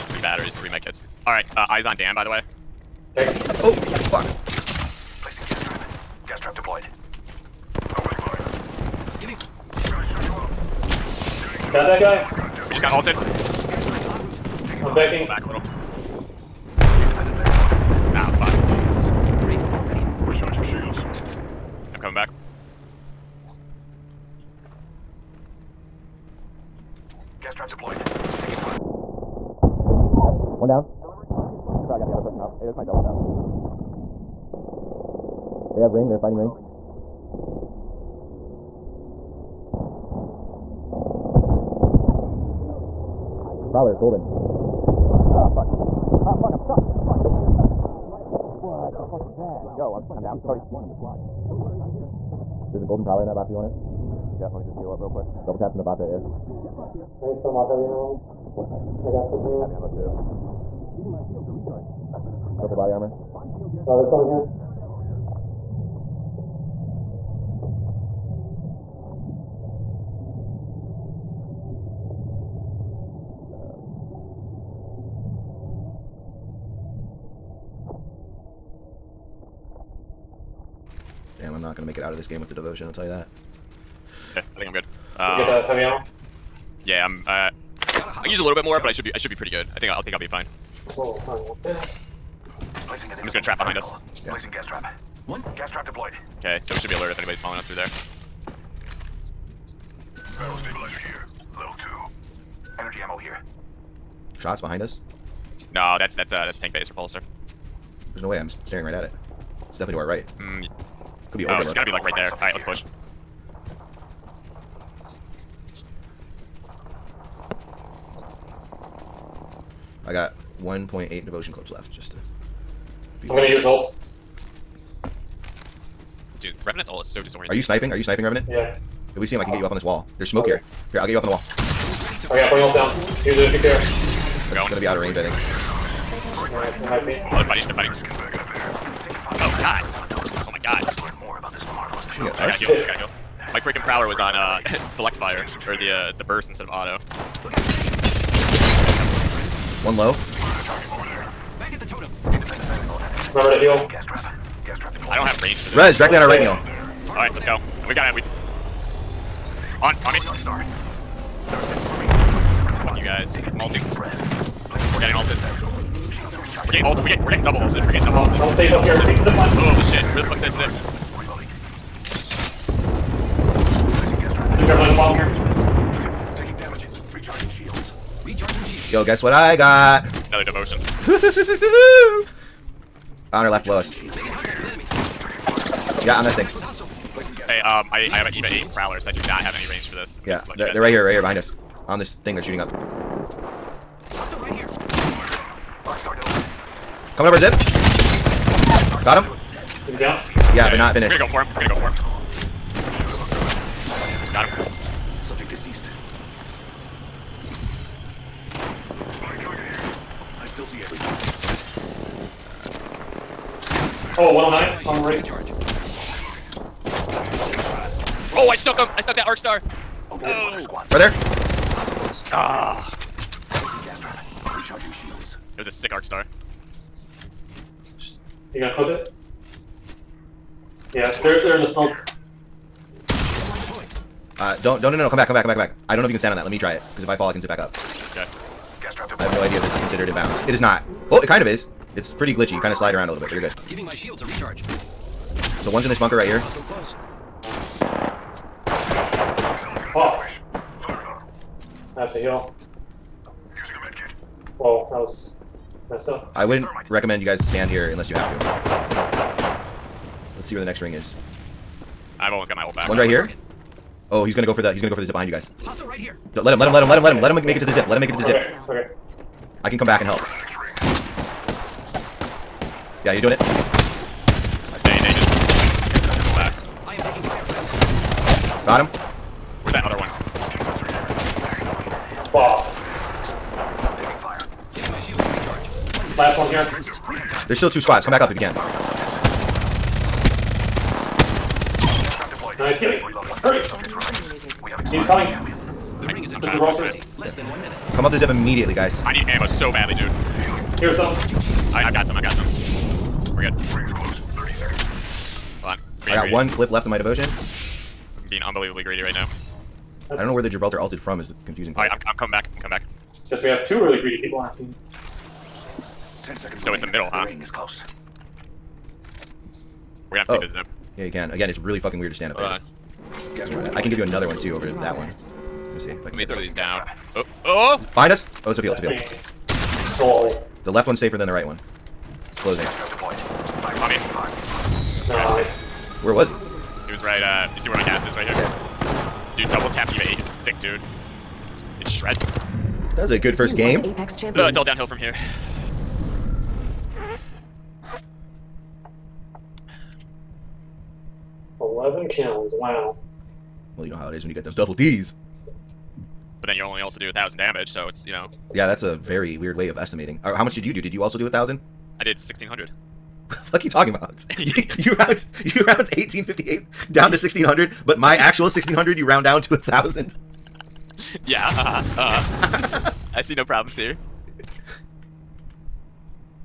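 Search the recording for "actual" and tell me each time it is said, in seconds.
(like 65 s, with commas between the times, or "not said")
368 s.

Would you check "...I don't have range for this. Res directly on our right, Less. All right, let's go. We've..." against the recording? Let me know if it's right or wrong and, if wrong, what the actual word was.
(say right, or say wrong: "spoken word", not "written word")
wrong: "Neil", not "Less".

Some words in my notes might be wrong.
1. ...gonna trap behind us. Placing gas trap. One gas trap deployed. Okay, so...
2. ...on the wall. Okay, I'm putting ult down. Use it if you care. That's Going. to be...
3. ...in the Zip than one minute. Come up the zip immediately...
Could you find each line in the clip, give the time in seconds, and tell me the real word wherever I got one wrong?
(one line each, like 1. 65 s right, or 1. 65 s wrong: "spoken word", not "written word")
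1. 93 s right
2. 131 s right
3. 296 s wrong: "Less", not "Zip".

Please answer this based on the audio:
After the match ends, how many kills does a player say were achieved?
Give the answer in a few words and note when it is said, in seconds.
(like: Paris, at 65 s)
11, at 351 s.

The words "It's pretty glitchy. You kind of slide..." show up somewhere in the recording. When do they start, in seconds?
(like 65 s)
241 s.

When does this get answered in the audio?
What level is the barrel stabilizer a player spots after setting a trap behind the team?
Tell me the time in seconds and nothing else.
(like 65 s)
101 s.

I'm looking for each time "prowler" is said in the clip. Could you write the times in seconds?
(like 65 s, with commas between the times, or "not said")
43 s, 53 s, 143 s, 188 s.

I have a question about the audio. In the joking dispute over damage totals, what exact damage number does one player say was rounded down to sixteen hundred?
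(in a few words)
1858.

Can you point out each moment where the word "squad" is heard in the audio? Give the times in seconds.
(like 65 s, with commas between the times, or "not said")
50 s, 287 s.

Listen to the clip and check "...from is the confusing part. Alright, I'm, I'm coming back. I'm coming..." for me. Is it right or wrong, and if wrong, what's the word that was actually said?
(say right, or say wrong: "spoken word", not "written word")
right.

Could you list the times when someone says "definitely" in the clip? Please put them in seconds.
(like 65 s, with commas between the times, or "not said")
109 s.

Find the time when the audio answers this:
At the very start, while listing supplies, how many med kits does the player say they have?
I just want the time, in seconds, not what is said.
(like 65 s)
0 s.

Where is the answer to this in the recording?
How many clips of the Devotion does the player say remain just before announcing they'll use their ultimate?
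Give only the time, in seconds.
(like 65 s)
120 s.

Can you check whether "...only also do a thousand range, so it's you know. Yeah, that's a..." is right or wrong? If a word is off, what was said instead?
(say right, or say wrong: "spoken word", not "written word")
wrong: "damage", not "range".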